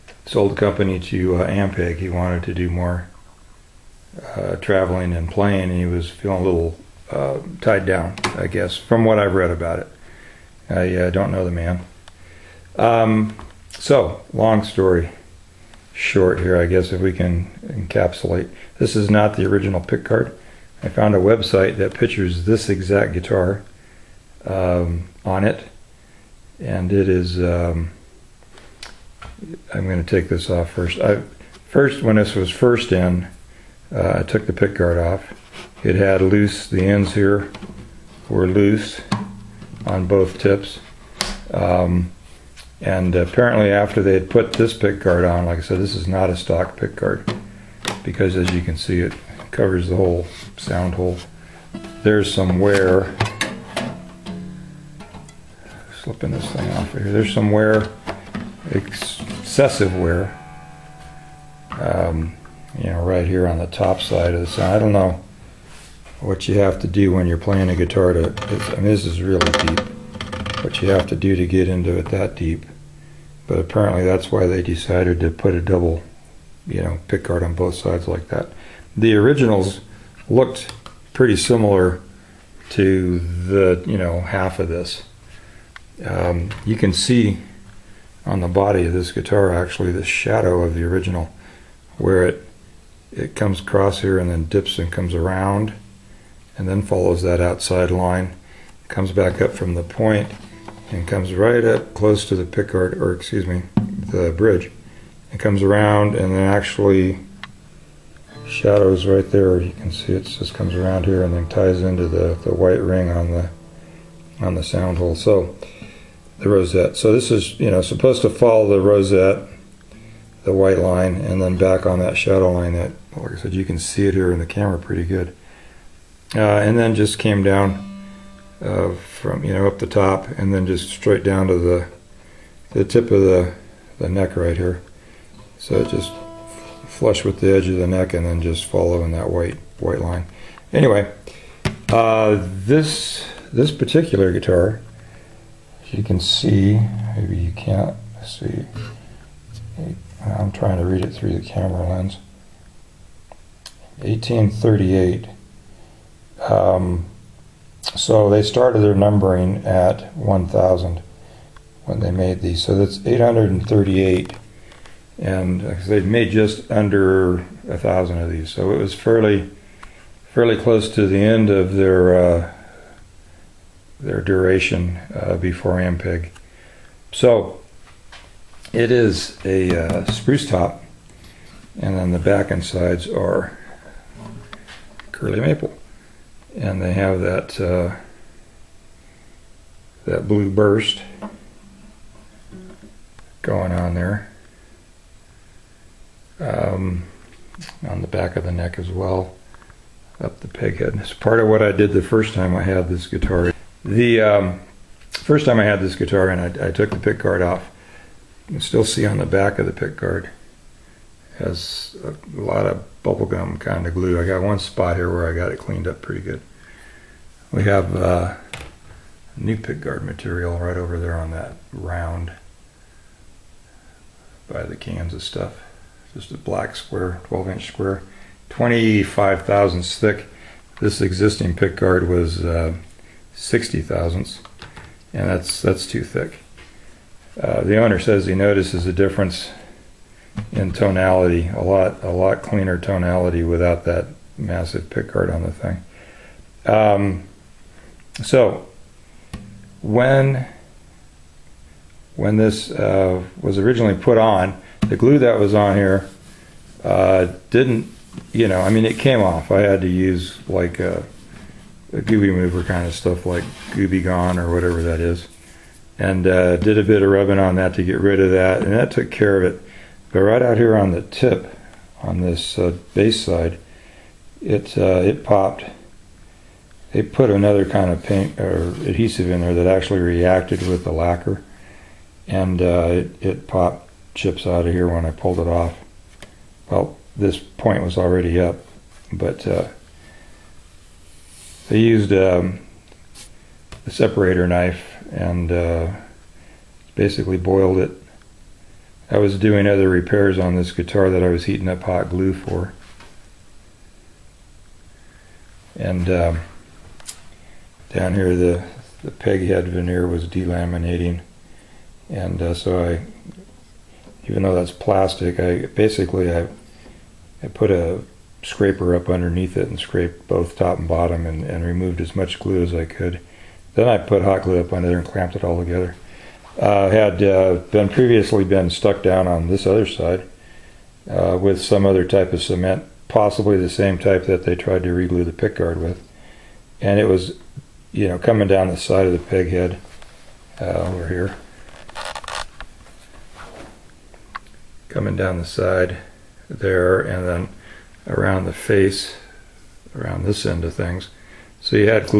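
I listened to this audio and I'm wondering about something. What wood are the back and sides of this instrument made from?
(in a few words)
curly maple.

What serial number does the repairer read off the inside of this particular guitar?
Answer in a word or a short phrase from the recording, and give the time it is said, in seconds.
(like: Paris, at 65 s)
1838, at 154 s.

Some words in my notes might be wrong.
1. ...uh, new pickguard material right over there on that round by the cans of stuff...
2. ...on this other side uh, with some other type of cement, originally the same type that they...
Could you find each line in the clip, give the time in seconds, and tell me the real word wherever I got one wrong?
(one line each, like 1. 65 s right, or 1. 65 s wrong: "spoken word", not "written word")
1. 217 s right
2. 329 s wrong: "possibly", not "originally".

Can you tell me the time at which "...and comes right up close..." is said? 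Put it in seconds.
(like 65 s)
100 s.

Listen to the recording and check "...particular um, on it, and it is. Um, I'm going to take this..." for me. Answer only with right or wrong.
wrong.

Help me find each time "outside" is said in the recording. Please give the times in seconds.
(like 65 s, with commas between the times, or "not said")
97 s.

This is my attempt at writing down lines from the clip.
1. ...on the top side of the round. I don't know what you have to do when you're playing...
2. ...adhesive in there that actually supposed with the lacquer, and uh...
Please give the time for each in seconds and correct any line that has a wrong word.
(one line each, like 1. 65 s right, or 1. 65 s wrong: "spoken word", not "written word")
1. 63 s wrong: "sound", not "round"
2. 278 s wrong: "reacted", not "supposed".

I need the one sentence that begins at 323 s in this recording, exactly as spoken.
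Then I put hot glue up under there and clamped it all together.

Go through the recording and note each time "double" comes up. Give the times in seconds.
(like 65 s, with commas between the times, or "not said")
75 s.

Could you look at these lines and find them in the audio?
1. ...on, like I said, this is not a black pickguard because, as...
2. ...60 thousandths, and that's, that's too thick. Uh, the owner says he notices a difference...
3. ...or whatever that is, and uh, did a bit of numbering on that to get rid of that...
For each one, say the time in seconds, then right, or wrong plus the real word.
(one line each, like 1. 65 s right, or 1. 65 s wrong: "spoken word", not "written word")
1. 45 s wrong: "stock", not "black"
2. 233 s right
3. 264 s wrong: "rubbing", not "numbering".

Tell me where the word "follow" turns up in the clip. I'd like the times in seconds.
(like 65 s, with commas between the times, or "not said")
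96 s, 118 s, 138 s.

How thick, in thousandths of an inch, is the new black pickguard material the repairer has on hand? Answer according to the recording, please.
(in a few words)
25 thousandths.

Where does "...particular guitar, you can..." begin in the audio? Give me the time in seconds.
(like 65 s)
143 s.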